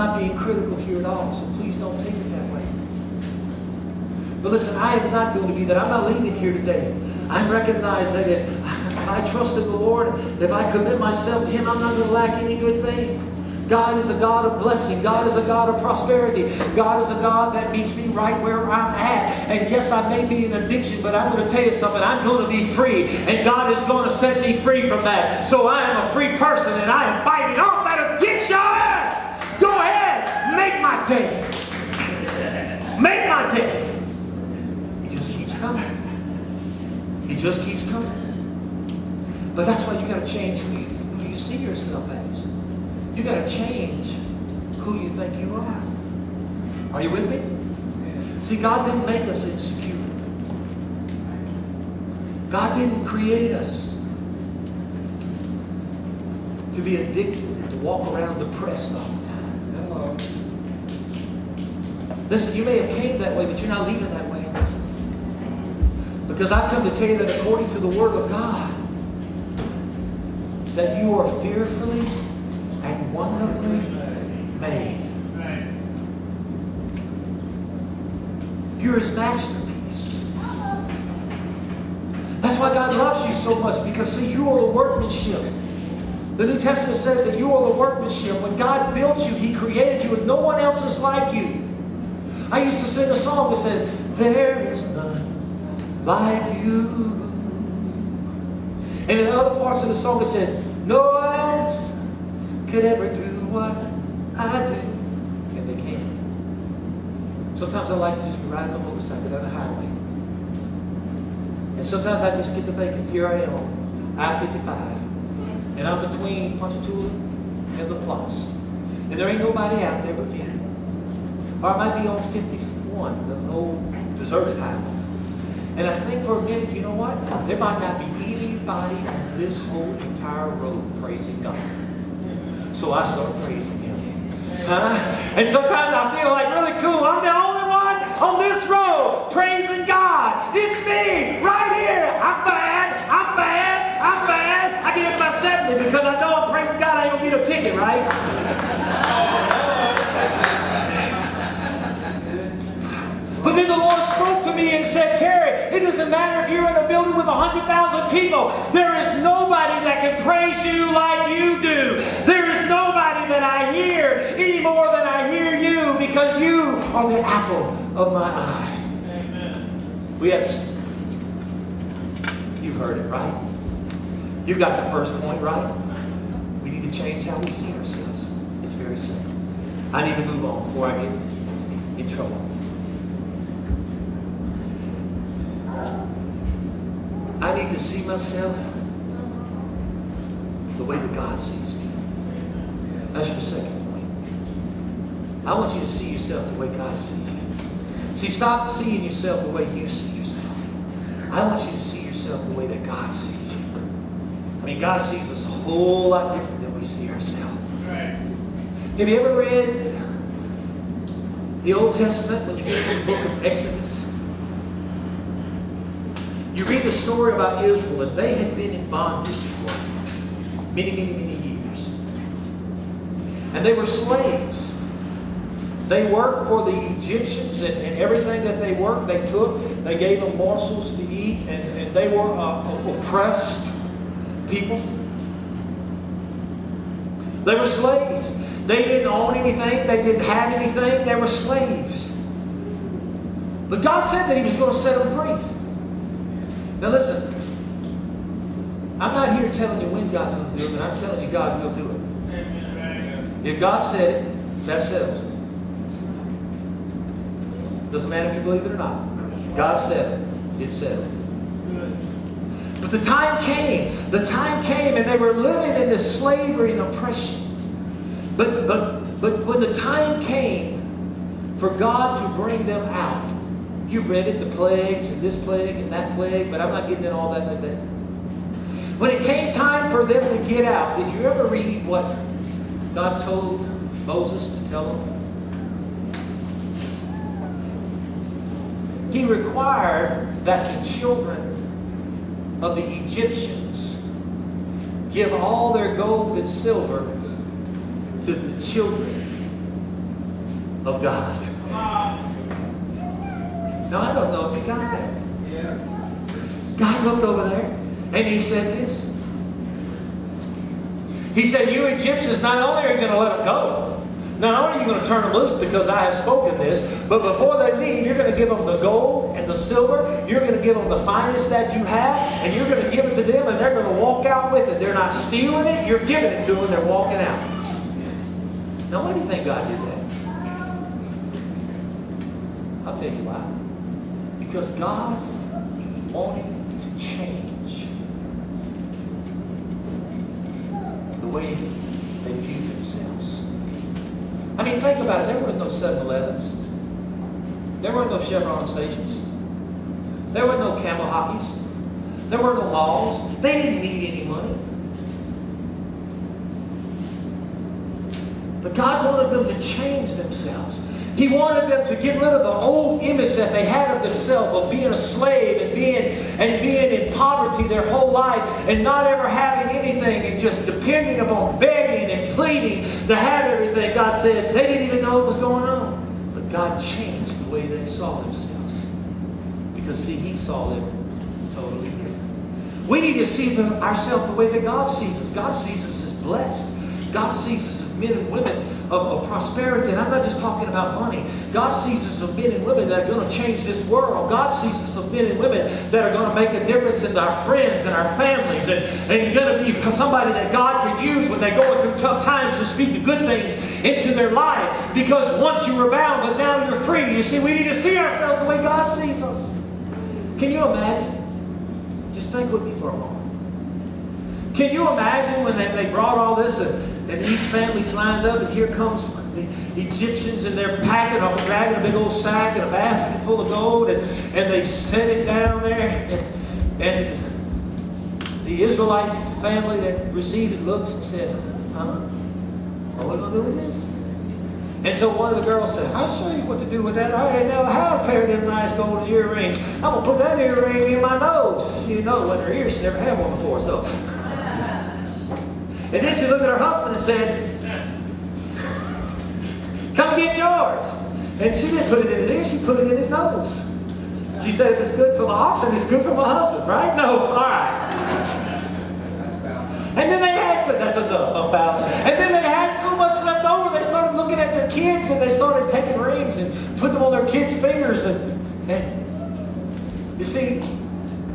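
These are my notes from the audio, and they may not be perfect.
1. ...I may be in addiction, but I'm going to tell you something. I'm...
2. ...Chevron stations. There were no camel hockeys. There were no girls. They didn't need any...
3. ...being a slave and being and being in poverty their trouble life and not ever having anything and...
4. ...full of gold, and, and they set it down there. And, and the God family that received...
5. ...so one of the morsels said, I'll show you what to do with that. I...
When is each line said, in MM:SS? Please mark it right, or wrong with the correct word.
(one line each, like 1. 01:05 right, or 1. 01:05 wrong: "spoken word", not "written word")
1. 00:19 right
2. 05:48 wrong: "malls", not "girls"
3. 06:04 wrong: "whole", not "trouble"
4. 07:03 wrong: "Israelite", not "God"
5. 07:14 wrong: "girls", not "morsels".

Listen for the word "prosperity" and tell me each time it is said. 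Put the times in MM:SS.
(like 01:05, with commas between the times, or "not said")
00:15, 06:29.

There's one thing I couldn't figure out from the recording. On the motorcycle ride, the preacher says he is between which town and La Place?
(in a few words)
Ponchatoula.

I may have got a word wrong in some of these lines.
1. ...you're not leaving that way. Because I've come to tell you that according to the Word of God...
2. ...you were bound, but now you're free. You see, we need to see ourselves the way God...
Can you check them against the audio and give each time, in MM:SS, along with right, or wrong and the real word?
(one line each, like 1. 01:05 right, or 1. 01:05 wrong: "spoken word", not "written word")
1. 01:03 right
2. 06:45 right.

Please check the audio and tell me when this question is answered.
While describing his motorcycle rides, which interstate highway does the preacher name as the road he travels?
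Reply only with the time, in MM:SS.
01:54.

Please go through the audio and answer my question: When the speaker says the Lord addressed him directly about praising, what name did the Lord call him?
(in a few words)
Terry.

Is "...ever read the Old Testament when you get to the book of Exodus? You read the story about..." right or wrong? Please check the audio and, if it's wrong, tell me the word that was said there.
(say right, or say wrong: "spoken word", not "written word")
right.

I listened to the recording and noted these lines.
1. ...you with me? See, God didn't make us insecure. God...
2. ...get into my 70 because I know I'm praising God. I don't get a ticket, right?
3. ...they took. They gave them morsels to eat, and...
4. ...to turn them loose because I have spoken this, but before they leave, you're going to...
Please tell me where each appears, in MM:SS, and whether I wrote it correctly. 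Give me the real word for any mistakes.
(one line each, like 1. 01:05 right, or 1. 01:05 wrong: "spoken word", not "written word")
1. 00:47 right
2. 02:24 right
3. 03:49 right
4. 05:15 right.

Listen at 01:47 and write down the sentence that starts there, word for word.
Sometimes I like to just be riding a motorcycle down the highway.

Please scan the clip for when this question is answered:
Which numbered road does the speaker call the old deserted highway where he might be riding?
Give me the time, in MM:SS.
02:02.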